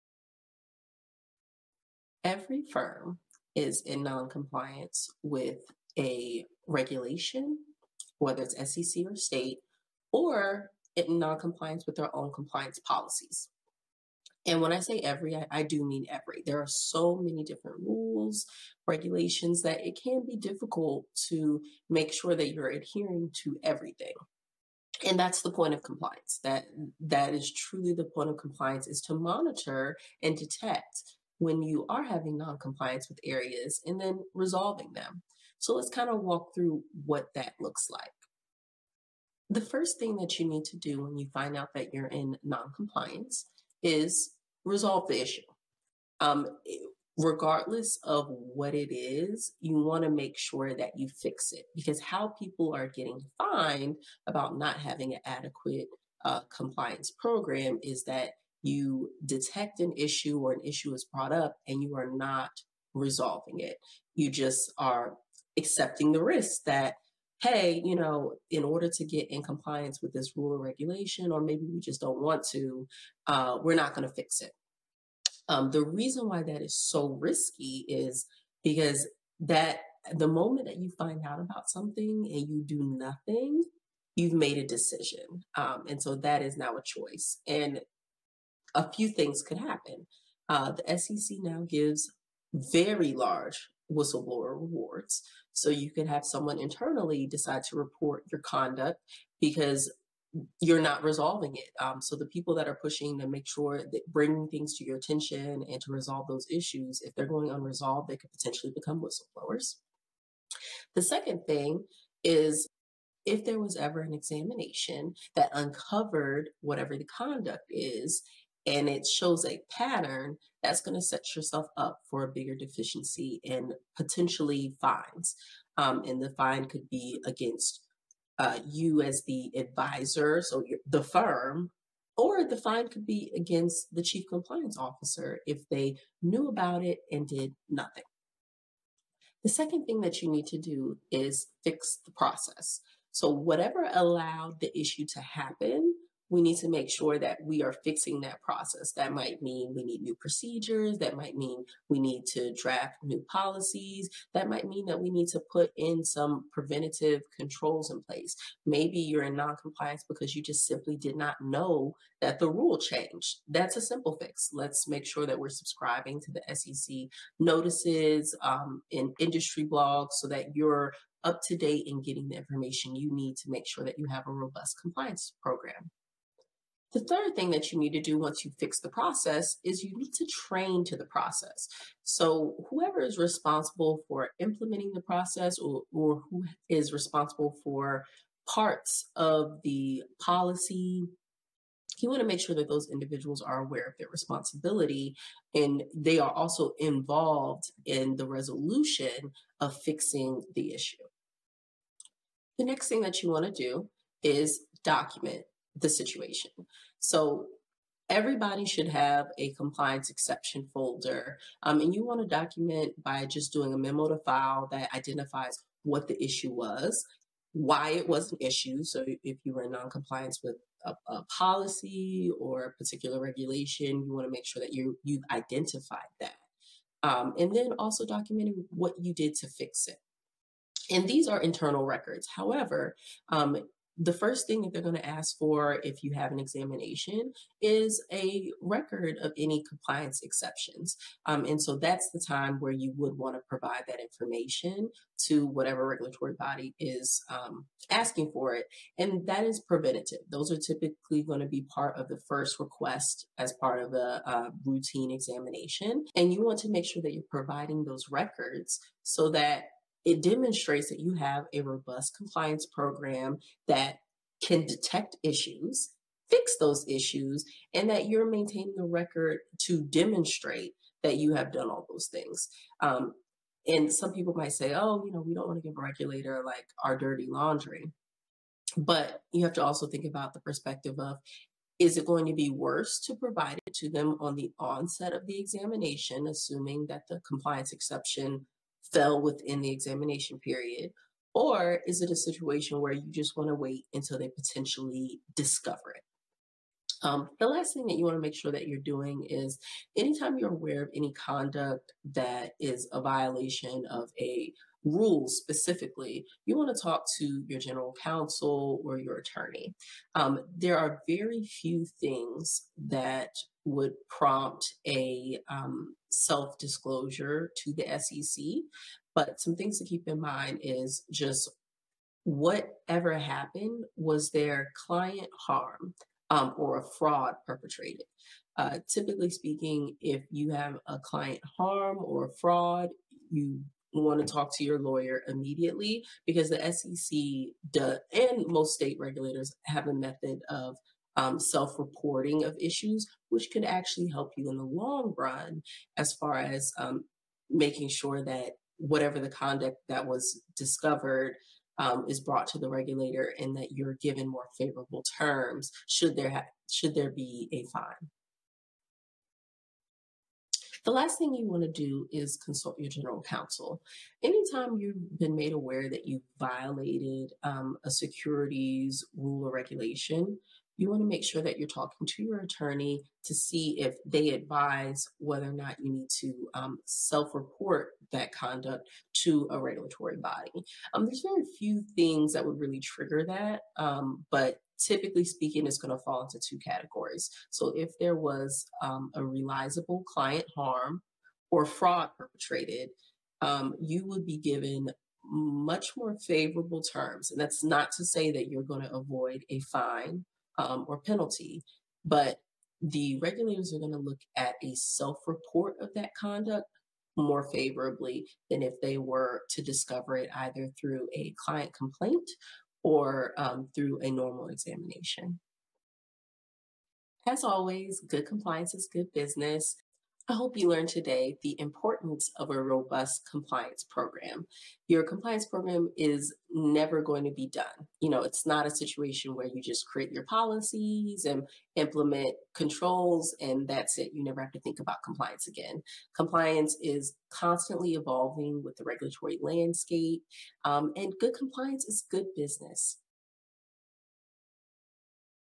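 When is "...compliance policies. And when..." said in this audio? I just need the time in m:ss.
0:12.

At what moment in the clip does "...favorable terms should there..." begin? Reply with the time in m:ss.
5:54.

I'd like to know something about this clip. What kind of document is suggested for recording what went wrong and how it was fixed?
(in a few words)
memo to file.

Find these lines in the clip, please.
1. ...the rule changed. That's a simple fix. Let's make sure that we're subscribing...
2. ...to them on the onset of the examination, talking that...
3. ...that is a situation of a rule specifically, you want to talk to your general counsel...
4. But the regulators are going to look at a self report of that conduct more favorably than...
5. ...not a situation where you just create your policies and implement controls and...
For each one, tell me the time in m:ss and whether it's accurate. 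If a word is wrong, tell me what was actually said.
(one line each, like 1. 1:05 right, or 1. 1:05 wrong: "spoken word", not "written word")
1. 2:42 right
2. 4:43 wrong: "assuming", not "talking"
3. 5:02 wrong: "violation", not "situation"
4. 6:42 right
5. 7:08 right.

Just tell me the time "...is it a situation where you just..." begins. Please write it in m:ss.
4:51.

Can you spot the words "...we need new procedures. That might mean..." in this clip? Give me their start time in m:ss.
2:29.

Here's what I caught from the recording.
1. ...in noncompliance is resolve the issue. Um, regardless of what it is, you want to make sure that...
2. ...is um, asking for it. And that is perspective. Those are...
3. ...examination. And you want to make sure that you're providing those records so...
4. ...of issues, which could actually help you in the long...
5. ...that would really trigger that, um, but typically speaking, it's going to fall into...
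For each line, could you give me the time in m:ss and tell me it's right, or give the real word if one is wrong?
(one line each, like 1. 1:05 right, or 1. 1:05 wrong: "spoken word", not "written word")
1. 0:42 right
2. 4:06 wrong: "preventative", not "perspective"
3. 4:15 right
4. 5:42 right
5. 6:22 right.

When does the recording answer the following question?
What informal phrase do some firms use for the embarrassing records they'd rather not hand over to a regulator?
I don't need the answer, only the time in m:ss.
4:36.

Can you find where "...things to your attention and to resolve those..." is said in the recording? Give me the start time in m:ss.
1:44.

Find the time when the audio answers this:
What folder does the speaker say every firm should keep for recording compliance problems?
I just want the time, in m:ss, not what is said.
3:29.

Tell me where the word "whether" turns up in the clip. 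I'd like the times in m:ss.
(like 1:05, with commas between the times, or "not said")
0:08, 6:15.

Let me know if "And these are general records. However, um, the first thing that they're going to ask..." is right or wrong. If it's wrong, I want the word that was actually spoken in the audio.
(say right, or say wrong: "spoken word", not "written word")
wrong: "internal", not "general".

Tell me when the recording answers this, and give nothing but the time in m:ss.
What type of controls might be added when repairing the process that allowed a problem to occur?
2:36.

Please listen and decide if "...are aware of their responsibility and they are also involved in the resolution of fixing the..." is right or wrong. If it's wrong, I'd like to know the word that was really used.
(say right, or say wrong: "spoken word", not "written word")
right.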